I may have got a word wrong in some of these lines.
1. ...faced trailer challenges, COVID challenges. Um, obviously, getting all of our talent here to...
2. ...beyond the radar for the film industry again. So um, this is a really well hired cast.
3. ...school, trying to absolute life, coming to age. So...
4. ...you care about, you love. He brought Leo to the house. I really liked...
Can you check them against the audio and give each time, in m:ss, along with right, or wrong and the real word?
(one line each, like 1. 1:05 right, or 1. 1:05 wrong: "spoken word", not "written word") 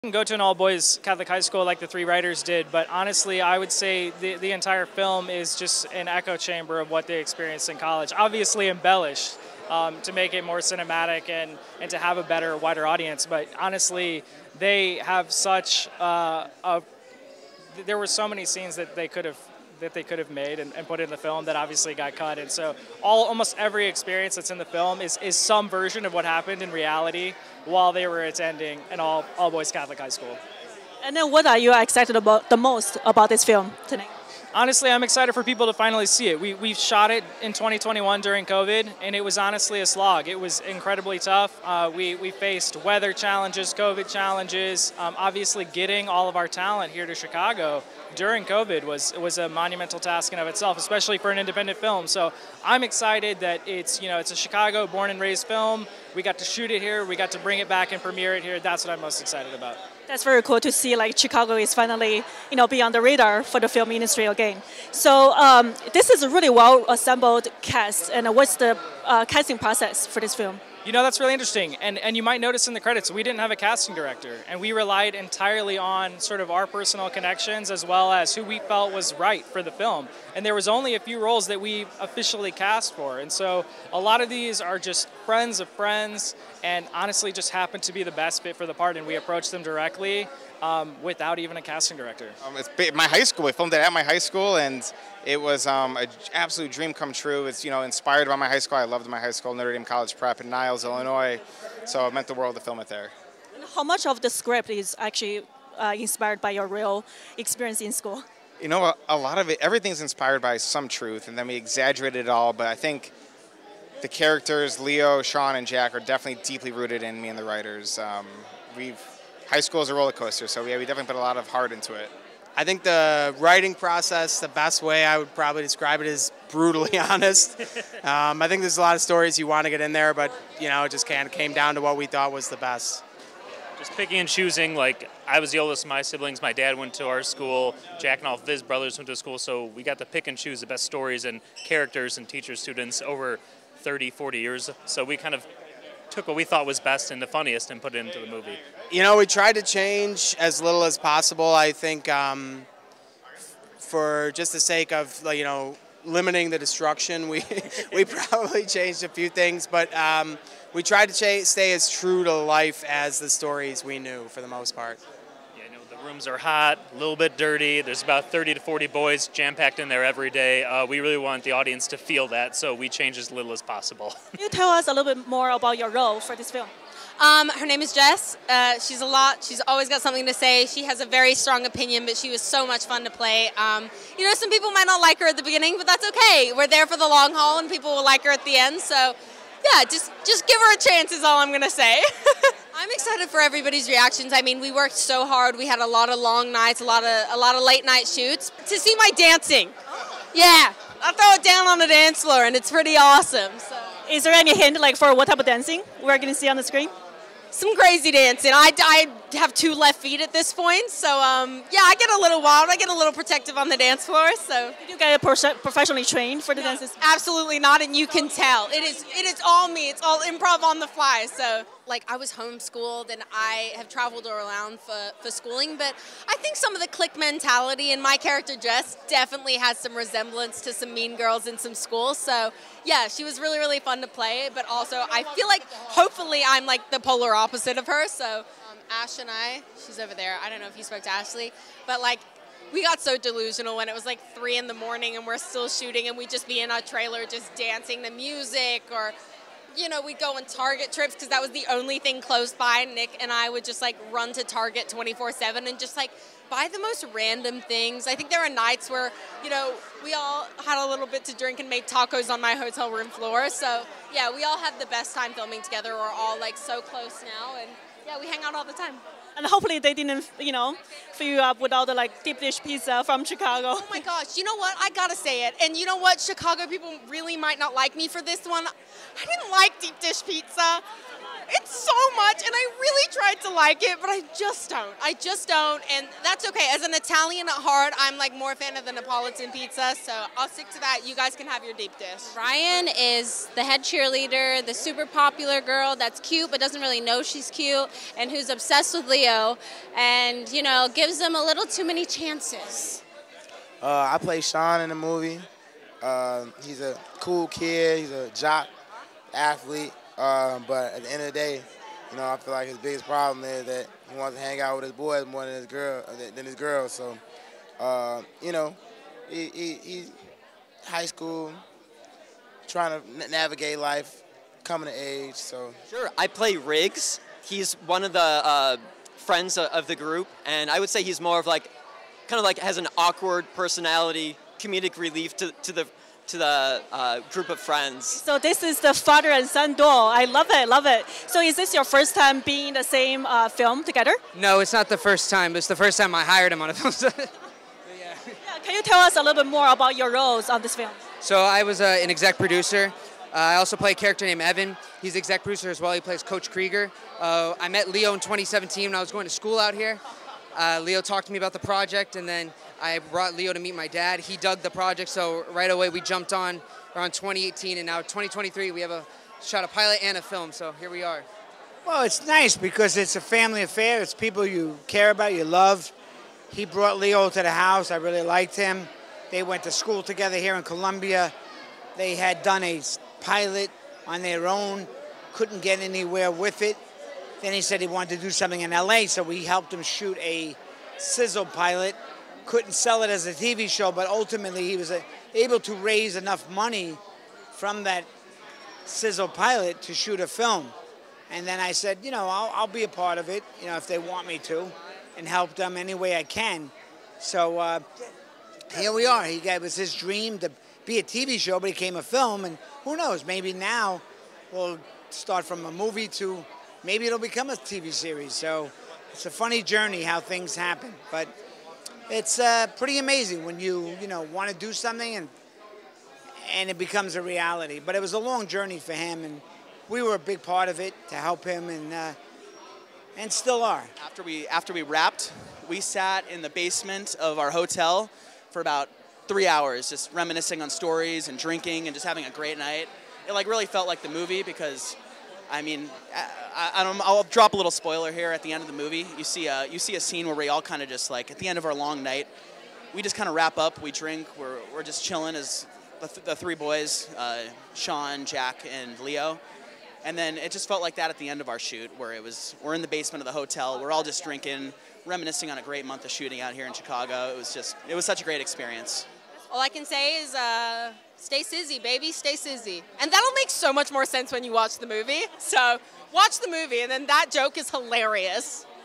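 1. 0:42 wrong: "weather", not "trailer"
2. 1:02 wrong: "assembled", not "hired"
3. 5:21 wrong: "navigate", not "absolute"
4. 6:14 right.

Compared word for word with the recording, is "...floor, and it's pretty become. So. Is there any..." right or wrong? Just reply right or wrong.
wrong.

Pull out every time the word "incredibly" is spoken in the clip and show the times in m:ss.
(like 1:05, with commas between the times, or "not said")
0:40.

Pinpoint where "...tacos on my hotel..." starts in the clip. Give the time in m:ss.
4:21.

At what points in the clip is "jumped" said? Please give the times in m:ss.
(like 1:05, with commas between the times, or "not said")
6:06.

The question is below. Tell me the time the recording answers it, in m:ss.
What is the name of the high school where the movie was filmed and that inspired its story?
1:39.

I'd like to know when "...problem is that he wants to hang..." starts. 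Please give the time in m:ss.
5:13.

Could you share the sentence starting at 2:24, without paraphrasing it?
So we kind of took what we thought was best and the funniest and put it into the movie.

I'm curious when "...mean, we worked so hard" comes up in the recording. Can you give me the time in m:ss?
3:14.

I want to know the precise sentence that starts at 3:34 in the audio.
So Did you get professionally trained for the no, dances?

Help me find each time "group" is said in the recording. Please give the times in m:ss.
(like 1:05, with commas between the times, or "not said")
5:29, 5:37.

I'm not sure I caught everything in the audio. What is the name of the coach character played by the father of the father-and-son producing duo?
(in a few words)
Coach Krieger.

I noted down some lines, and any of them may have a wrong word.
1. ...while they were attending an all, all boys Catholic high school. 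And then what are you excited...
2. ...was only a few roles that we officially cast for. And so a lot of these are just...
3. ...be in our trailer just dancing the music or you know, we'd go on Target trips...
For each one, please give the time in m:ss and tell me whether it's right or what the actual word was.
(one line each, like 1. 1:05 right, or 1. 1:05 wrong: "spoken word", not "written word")
1. 0:27 right
2. 1:20 right
3. 4:06 right.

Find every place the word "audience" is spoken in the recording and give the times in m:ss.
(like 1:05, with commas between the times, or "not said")
0:12, 2:51.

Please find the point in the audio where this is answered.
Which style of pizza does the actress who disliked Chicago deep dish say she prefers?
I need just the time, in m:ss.
4:48.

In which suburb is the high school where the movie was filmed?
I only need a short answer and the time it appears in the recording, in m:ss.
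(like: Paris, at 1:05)
Niles, Illinois, at 1:40.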